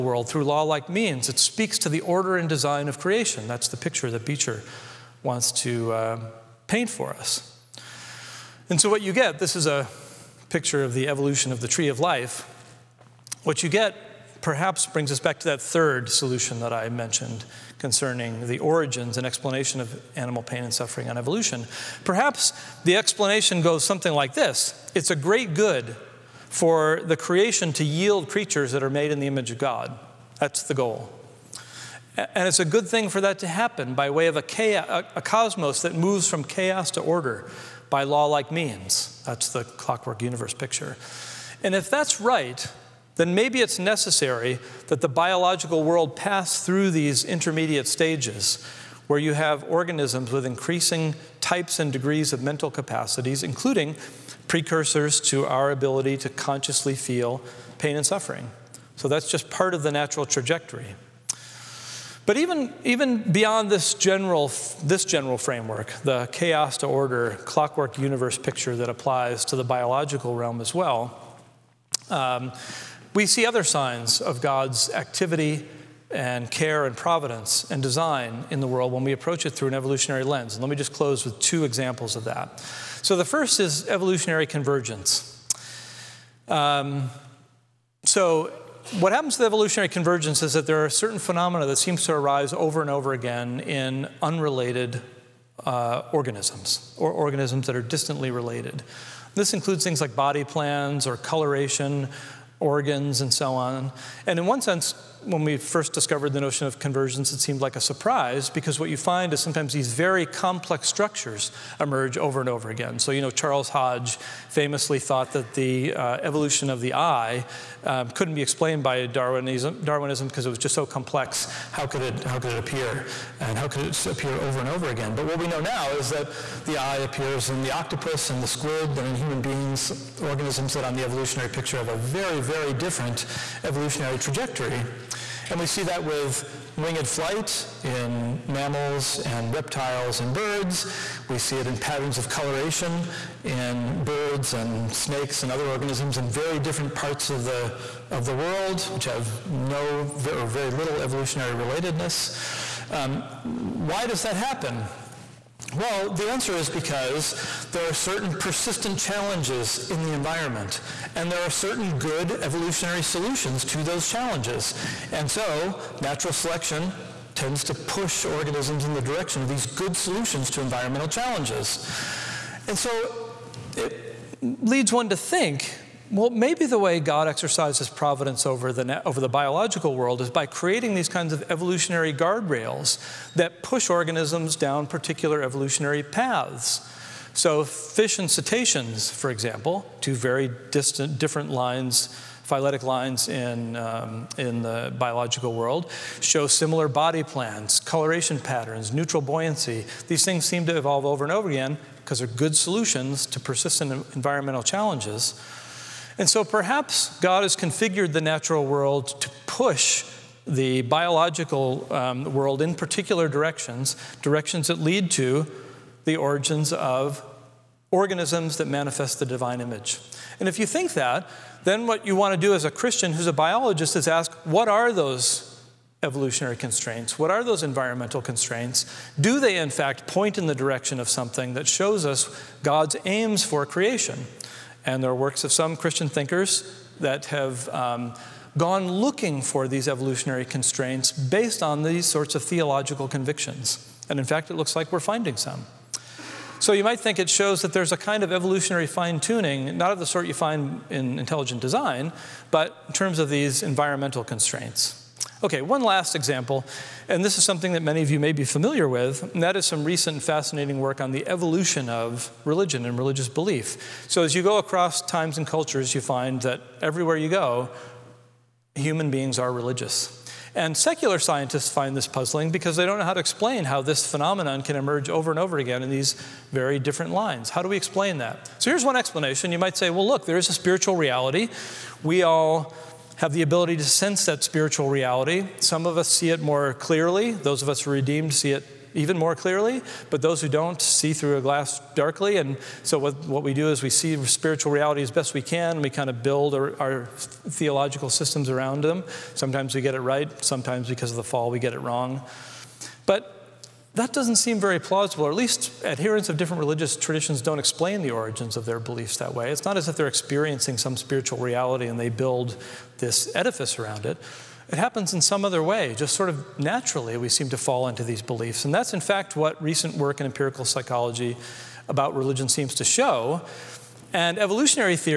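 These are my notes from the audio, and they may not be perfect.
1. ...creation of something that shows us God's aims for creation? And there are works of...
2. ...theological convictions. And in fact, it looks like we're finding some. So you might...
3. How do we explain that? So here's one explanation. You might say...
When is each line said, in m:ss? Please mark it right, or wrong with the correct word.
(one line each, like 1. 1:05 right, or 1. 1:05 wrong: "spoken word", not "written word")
1. 3:50 wrong: "direction", not "creation"
2. 4:02 right
3. 4:37 right.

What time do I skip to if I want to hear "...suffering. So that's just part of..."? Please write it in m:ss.
0:58.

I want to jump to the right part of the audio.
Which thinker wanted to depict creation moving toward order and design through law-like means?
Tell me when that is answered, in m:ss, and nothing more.
0:04.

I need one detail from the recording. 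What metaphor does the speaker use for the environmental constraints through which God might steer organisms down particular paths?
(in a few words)
Evolutionary guardrails.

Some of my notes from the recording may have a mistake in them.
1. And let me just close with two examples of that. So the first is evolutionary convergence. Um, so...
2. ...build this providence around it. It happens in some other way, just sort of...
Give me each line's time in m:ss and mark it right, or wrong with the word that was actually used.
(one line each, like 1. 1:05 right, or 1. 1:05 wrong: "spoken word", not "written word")
1. 1:20 right
2. 5:12 wrong: "edifice", not "providence".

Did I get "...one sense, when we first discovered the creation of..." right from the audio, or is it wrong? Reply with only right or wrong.
wrong.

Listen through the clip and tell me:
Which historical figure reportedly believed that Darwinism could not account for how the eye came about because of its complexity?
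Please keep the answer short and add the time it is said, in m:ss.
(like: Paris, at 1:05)
Charles Hodge, at 1:53.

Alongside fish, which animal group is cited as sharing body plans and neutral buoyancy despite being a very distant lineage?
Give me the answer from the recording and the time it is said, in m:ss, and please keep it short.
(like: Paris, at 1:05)
Cetaceans, at 3:08.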